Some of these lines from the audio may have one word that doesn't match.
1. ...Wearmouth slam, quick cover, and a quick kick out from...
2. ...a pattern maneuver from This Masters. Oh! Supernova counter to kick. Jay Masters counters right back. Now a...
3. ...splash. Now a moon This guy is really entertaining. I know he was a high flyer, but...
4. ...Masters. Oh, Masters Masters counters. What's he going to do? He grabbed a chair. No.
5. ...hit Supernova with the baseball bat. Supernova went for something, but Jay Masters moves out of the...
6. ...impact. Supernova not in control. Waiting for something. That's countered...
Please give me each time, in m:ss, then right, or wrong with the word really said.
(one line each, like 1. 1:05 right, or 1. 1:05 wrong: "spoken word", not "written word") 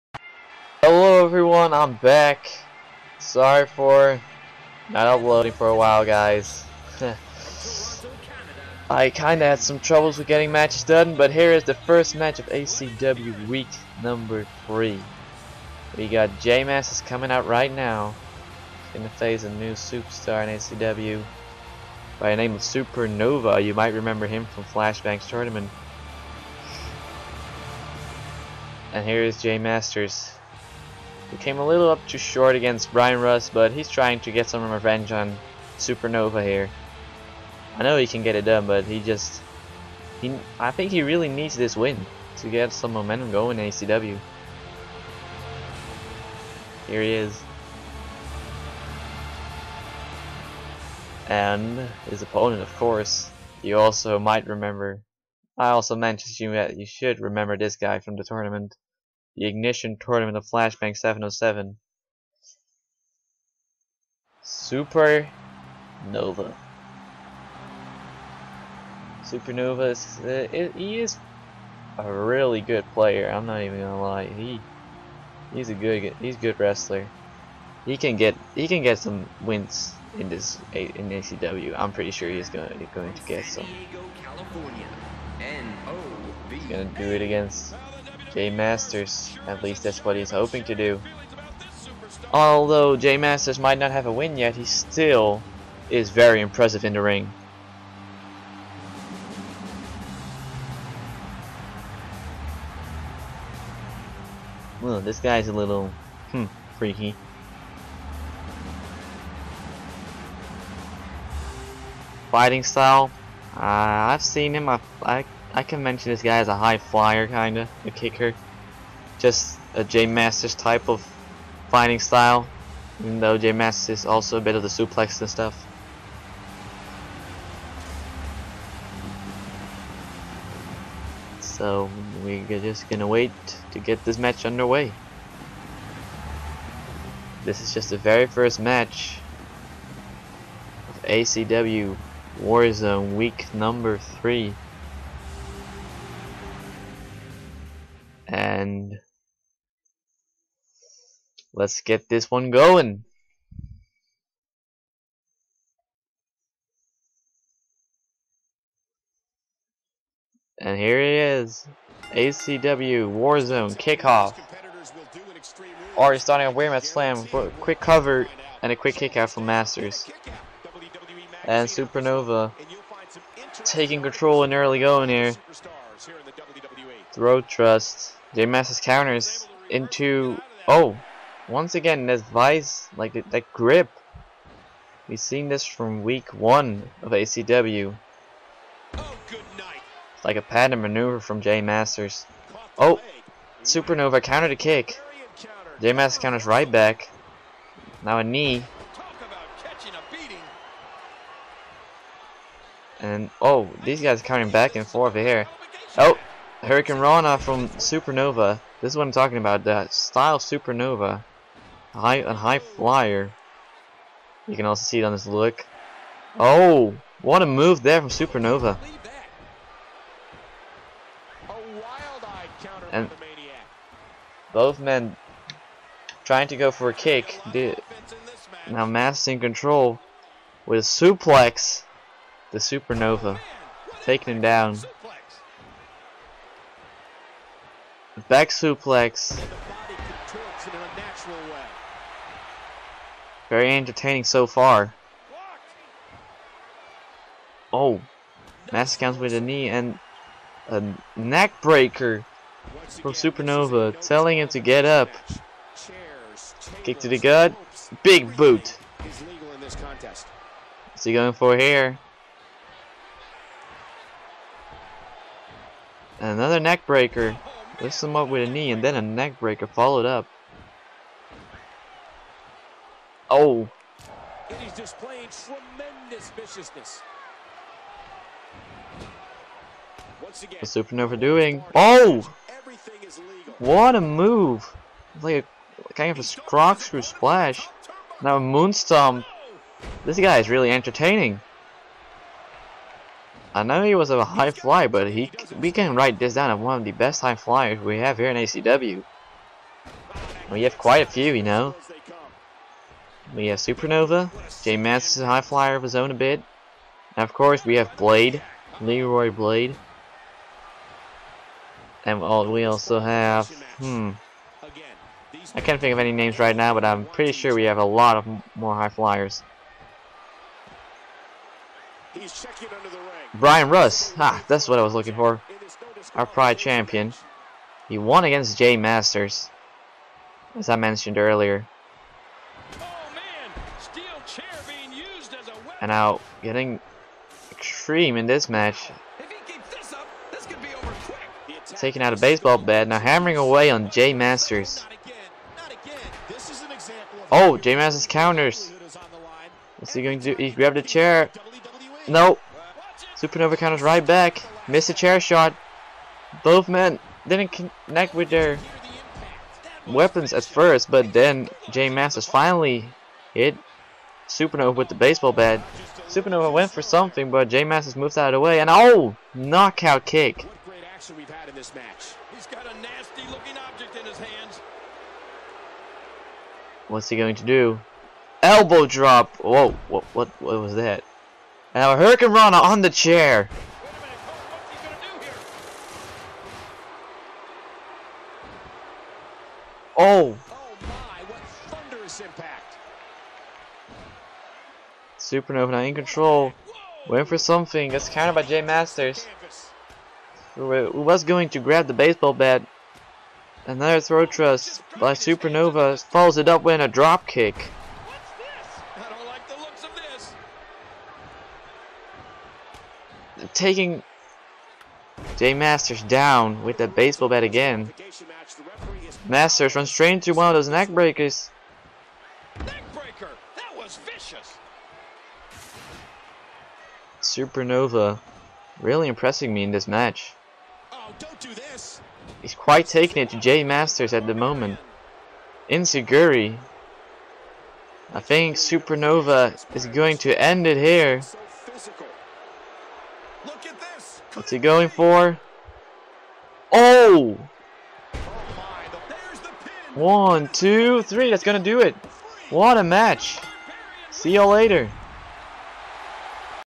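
1. 2:46 right
2. 3:10 wrong: "Jay", not "This"
3. 4:47 right
4. 5:44 wrong: "Jay", not "Masters"
5. 6:03 right
6. 6:32 right.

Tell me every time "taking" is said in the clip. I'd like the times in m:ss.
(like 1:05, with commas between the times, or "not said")
2:53, 3:54, 5:41, 6:53, 7:12.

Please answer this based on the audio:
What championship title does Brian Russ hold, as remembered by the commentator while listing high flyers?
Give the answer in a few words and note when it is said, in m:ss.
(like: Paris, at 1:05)
Pride champion, at 5:26.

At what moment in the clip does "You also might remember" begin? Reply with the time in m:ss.
0:53.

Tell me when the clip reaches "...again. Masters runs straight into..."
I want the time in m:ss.
6:57.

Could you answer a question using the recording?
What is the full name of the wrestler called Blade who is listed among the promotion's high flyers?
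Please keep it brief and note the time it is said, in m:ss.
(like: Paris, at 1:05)
Leroy Blade, at 5:08.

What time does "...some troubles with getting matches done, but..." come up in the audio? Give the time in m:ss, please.
0:09.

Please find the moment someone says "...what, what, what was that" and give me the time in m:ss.
6:19.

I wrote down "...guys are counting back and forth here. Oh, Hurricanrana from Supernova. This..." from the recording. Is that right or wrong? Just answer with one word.
right.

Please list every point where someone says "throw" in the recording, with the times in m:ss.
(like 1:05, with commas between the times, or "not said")
2:57, 6:44.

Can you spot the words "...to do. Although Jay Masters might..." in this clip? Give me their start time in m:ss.
1:30.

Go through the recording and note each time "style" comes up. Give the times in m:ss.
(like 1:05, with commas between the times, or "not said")
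1:52, 2:01, 3:29.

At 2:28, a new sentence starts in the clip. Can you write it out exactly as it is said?
and let's get this one going.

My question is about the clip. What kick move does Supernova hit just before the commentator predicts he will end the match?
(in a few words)
Enzuigiri.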